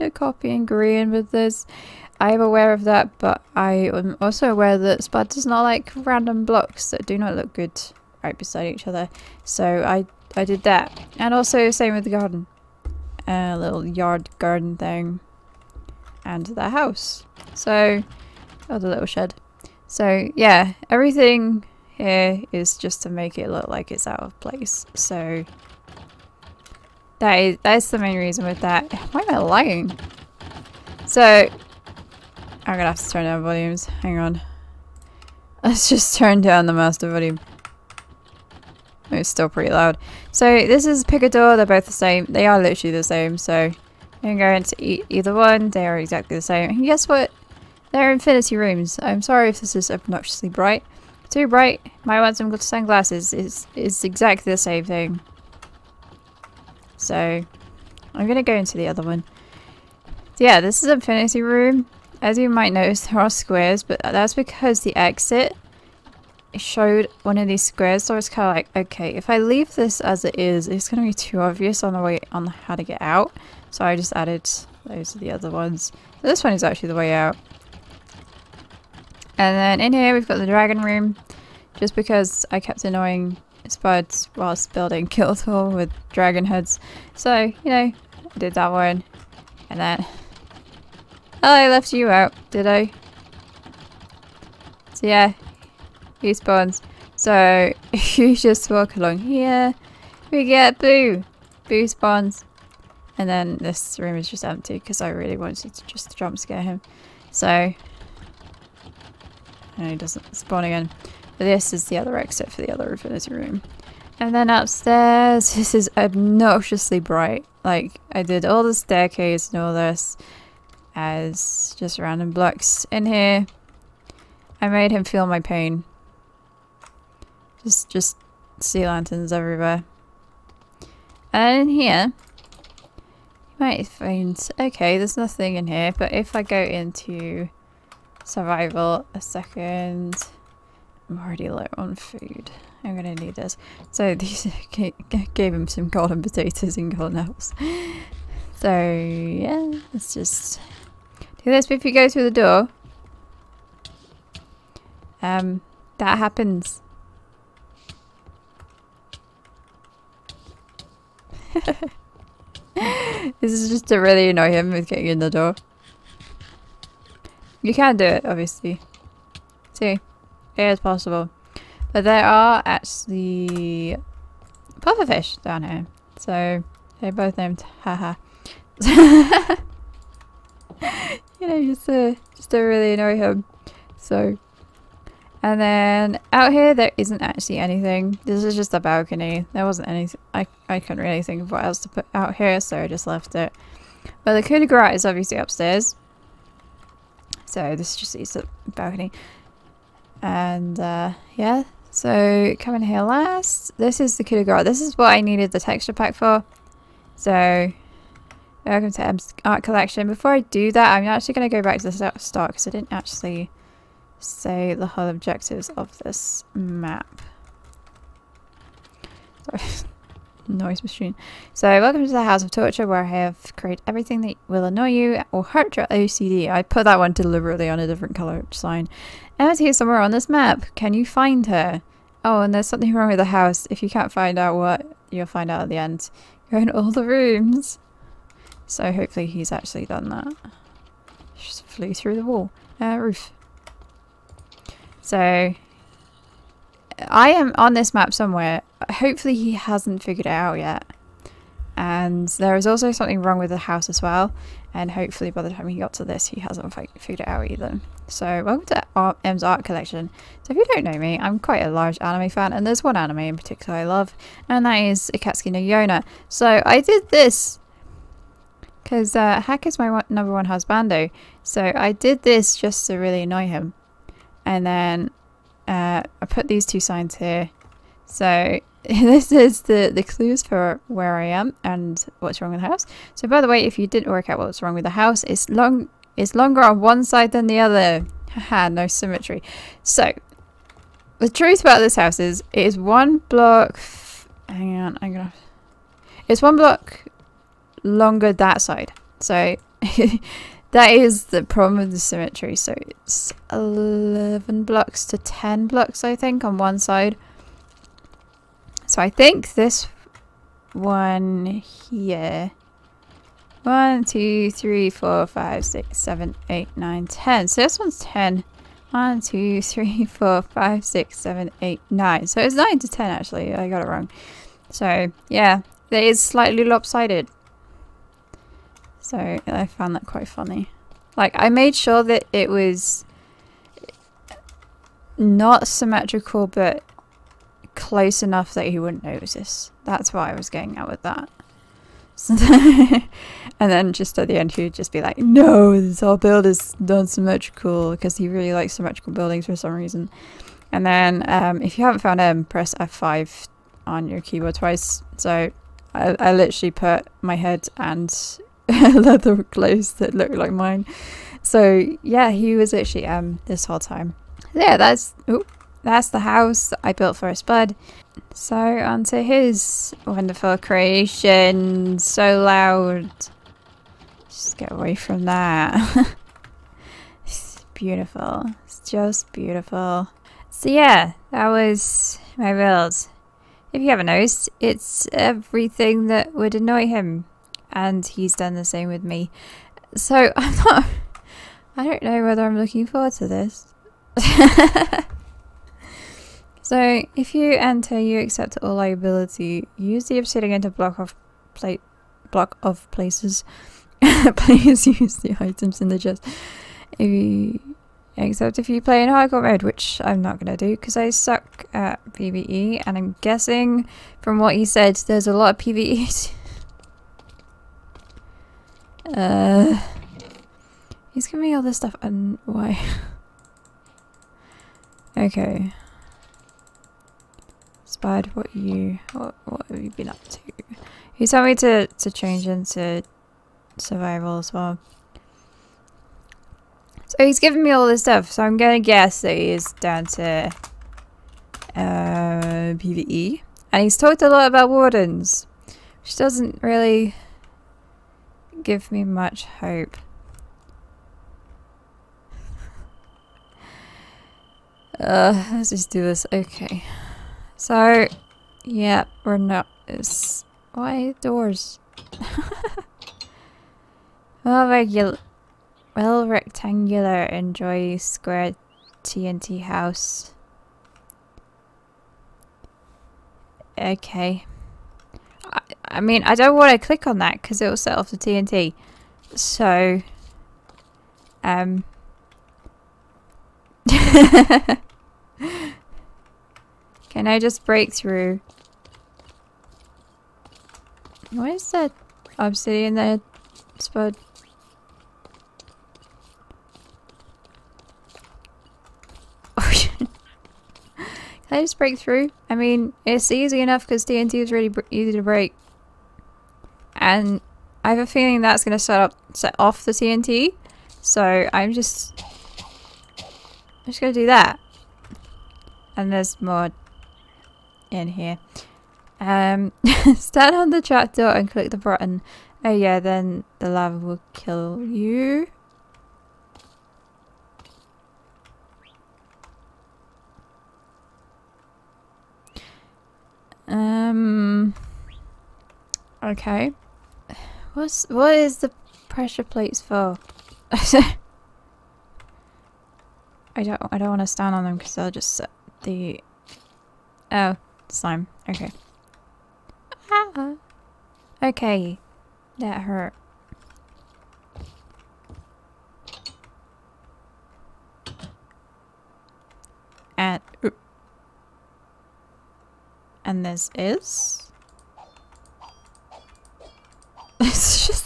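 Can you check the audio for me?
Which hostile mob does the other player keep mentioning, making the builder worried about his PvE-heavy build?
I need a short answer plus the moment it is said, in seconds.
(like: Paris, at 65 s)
Wardens, at 444 s.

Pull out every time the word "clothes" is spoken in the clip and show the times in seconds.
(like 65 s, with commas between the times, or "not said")
359 s.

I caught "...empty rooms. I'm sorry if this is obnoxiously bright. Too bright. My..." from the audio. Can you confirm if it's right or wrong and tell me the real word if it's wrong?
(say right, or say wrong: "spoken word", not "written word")
wrong: "infinity", not "empty".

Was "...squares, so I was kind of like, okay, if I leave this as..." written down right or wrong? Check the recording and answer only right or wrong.
right.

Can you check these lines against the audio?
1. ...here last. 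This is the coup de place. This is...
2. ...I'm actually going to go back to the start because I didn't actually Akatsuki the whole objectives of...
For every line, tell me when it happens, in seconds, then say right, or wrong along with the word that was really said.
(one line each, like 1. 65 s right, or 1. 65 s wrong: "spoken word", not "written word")
1. 202 s wrong: "grace", not "place"
2. 210 s wrong: "Say", not "Akatsuki".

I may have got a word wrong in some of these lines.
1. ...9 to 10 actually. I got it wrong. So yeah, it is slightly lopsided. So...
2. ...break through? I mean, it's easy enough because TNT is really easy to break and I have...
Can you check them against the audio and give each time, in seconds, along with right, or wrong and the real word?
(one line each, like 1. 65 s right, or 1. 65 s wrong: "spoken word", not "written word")
1. 322 s right
2. 501 s right.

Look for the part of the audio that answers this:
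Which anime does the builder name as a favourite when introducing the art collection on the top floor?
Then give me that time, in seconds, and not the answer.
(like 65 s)
265 s.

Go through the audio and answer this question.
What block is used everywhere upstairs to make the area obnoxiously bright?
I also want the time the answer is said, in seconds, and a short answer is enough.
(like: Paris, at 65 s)
Sea lanterns, at 128 s.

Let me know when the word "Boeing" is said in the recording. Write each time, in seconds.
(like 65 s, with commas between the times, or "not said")
not said.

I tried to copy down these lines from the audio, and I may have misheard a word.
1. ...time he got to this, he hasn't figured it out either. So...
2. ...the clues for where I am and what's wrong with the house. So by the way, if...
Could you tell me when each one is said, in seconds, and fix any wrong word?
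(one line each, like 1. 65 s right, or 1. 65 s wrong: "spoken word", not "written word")
1. 255 s right
2. 279 s right.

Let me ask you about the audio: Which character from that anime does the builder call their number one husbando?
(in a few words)
Hak.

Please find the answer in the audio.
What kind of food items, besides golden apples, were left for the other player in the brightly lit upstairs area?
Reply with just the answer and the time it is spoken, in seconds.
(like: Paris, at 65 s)
Golden potatoes, at 145 s.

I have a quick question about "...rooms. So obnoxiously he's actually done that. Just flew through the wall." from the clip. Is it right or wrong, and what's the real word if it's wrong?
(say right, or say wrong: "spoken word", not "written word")
wrong: "hopefully", not "obnoxiously".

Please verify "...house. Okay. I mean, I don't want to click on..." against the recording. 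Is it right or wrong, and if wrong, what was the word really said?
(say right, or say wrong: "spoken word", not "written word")
right.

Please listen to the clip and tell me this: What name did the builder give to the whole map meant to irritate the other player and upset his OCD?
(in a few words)
House of Torture.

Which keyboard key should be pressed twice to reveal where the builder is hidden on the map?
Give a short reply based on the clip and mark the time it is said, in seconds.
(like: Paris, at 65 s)
F5, at 352 s.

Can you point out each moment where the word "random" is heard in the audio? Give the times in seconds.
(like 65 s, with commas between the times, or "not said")
5 s, 121 s.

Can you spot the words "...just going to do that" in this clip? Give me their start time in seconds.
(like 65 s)
513 s.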